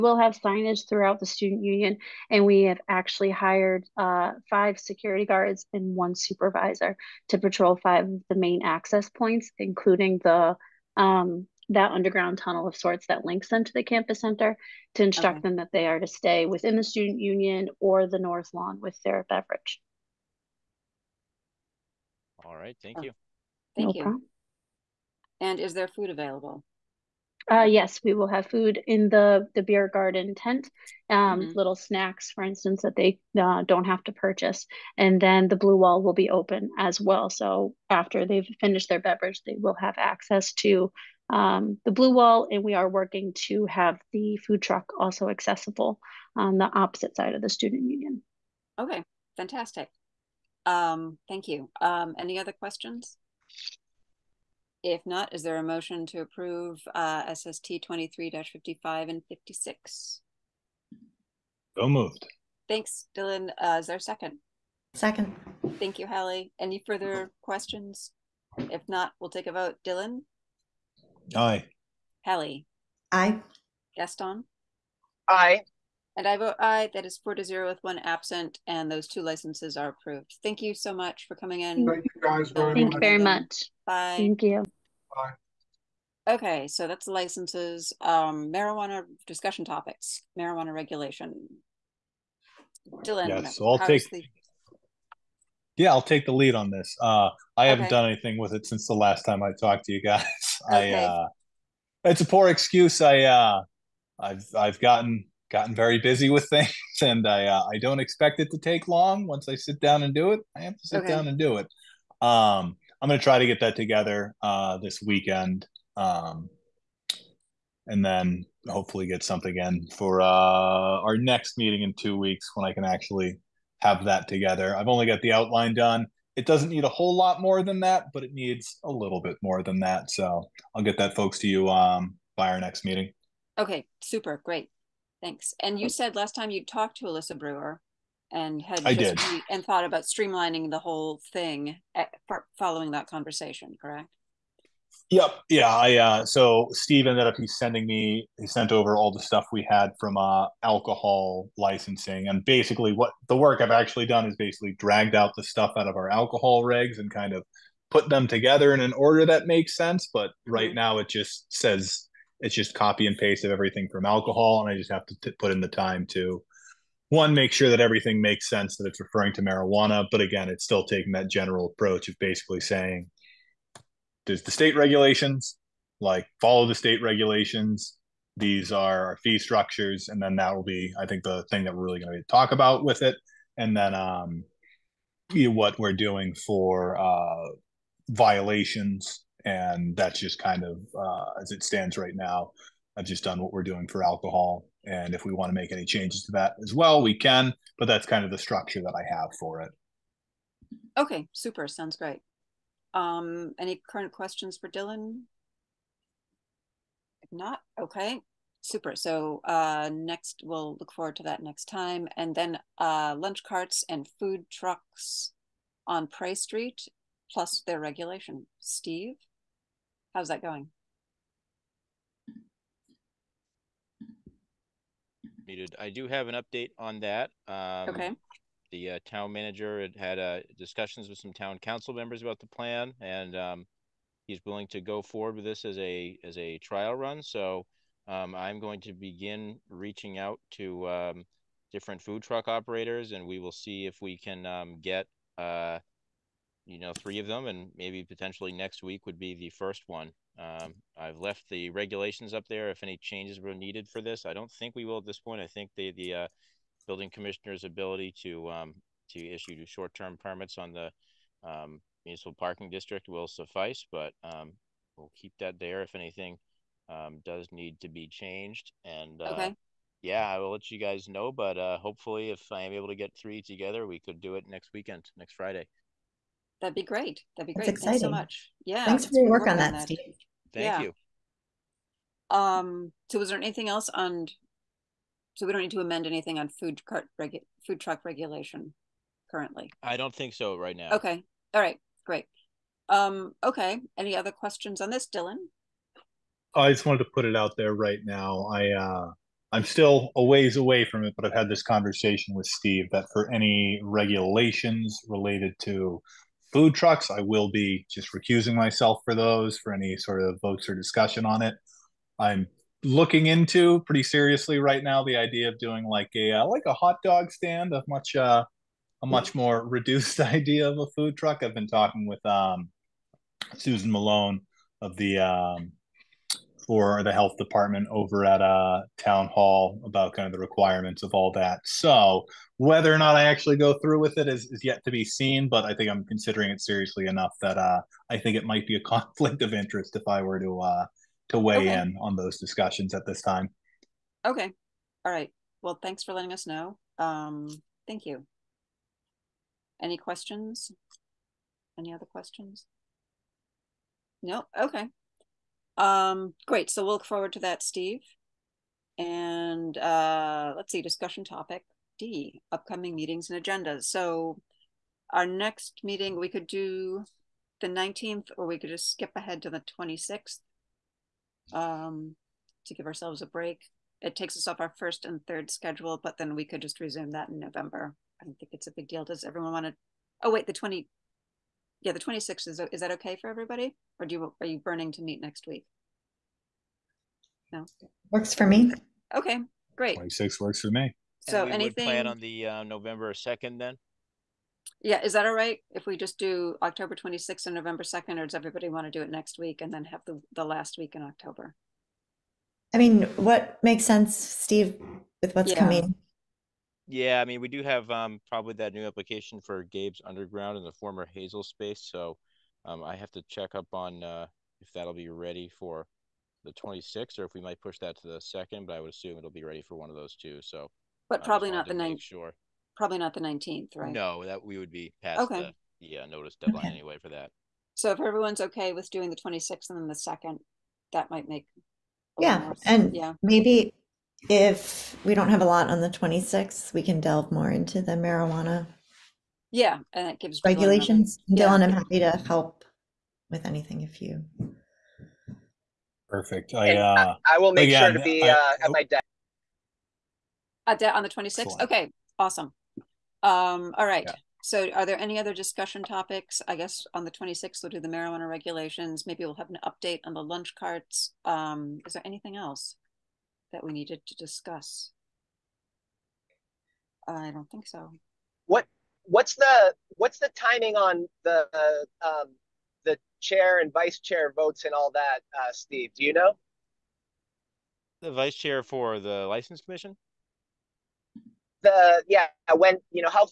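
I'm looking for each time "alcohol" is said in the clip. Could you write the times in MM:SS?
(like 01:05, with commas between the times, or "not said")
02:30, 02:36, 02:44, 03:14.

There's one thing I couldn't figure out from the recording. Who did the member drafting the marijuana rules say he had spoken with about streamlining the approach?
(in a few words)
Alisa Brewer.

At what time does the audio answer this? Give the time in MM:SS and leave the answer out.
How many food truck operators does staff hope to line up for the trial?
04:06.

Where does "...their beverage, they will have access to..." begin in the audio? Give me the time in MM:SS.
00:38.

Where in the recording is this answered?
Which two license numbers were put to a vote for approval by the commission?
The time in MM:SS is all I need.
00:57.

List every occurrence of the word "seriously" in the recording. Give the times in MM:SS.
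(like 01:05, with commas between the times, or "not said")
05:14, 05:36.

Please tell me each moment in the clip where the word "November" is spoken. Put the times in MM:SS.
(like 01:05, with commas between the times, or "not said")
06:17, 06:32, 06:37.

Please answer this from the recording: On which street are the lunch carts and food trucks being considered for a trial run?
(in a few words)
Pray Street.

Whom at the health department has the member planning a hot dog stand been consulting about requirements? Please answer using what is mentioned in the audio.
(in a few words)
Susan Malone.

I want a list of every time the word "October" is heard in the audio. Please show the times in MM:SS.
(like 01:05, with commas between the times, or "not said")
06:36, 06:41.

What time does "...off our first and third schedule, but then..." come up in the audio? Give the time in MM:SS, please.
06:14.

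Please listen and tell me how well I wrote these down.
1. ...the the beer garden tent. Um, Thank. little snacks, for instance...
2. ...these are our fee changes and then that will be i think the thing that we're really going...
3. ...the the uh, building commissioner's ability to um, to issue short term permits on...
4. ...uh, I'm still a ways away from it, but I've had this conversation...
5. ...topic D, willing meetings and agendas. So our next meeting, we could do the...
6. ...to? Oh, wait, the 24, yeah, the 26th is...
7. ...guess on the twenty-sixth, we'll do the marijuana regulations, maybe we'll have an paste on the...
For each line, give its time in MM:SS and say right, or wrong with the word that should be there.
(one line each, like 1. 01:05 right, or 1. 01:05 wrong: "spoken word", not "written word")
1. 00:29 wrong: "Mhm", not "Thank"
2. 02:58 wrong: "structures", not "changes"
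3. 04:15 right
4. 04:58 right
5. 06:01 wrong: "upcoming", not "willing"
6. 06:19 wrong: "20", not "24"
7. 07:36 wrong: "update", not "paste".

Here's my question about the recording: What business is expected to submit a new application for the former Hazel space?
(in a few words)
Gabe's Underground.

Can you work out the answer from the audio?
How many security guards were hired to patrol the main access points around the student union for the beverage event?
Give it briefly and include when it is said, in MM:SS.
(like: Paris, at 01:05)
5, at 00:04.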